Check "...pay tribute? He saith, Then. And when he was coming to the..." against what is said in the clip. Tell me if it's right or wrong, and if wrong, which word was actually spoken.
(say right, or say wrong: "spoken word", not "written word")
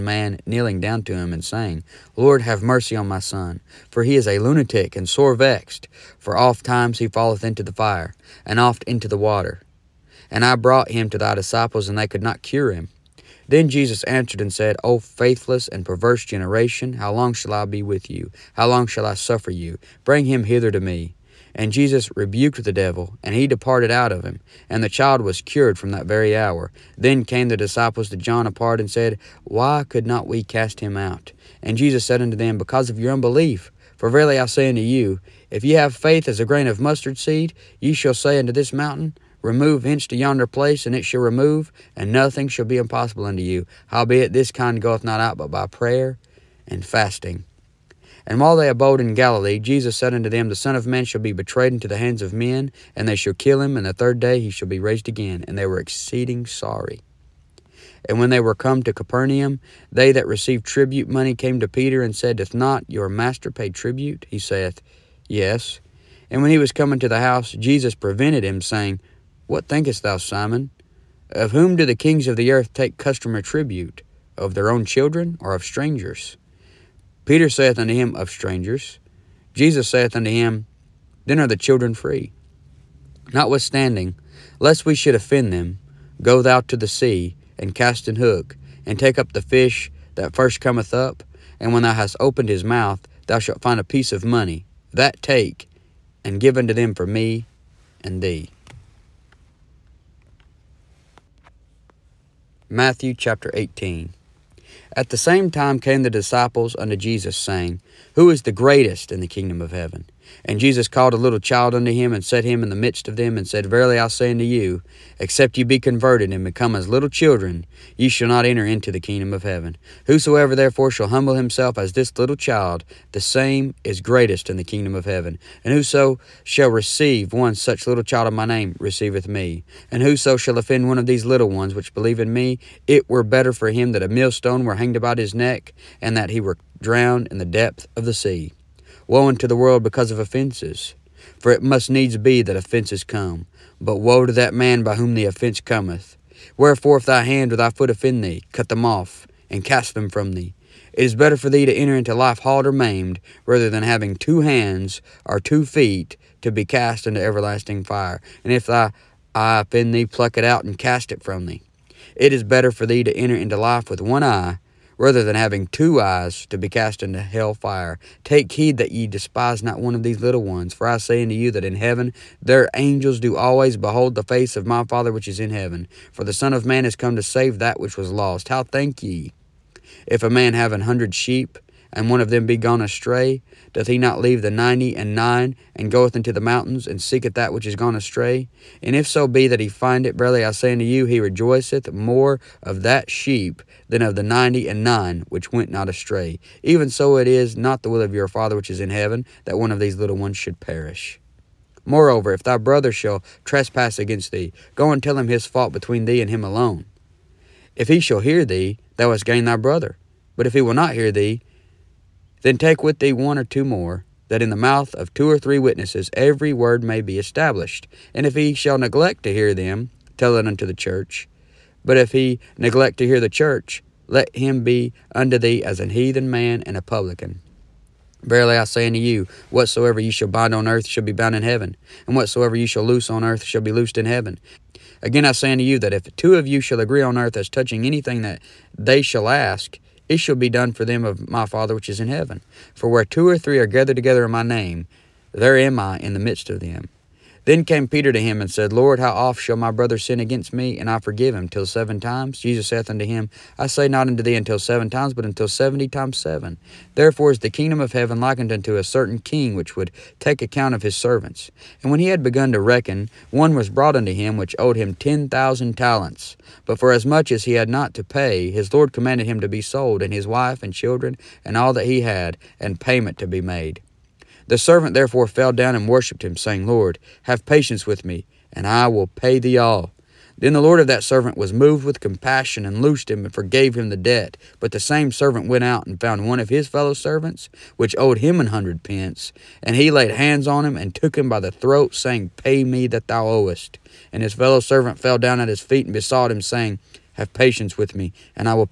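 wrong: "Yes", not "Then".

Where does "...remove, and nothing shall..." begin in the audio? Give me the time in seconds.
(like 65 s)
41 s.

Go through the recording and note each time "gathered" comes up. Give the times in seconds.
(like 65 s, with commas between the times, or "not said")
243 s.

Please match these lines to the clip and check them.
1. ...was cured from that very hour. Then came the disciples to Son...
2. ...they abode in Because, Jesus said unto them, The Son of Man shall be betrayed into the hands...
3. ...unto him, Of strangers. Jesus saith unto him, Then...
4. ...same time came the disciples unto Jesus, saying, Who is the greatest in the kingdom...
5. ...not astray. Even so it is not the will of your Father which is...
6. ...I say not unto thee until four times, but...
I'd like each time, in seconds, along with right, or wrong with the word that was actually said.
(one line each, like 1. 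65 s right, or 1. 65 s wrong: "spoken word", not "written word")
1. 25 s wrong: "John", not "Son"
2. 48 s wrong: "Galilee", not "Because"
3. 77 s right
4. 105 s right
5. 195 s right
6. 253 s wrong: "seven", not "four".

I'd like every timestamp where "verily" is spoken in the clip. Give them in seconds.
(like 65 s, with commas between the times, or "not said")
34 s, 113 s, 190 s, 228 s.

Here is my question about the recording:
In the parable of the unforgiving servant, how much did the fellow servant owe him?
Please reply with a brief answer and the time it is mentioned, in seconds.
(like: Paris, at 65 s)
100 pence, at 288 s.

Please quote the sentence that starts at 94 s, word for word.
That take, and give unto them for me and thee.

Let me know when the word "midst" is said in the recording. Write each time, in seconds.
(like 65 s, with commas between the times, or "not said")
112 s, 246 s.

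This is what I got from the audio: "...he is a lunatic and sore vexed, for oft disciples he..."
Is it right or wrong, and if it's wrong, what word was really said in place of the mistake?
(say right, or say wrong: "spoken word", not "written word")
wrong: "times", not "disciples".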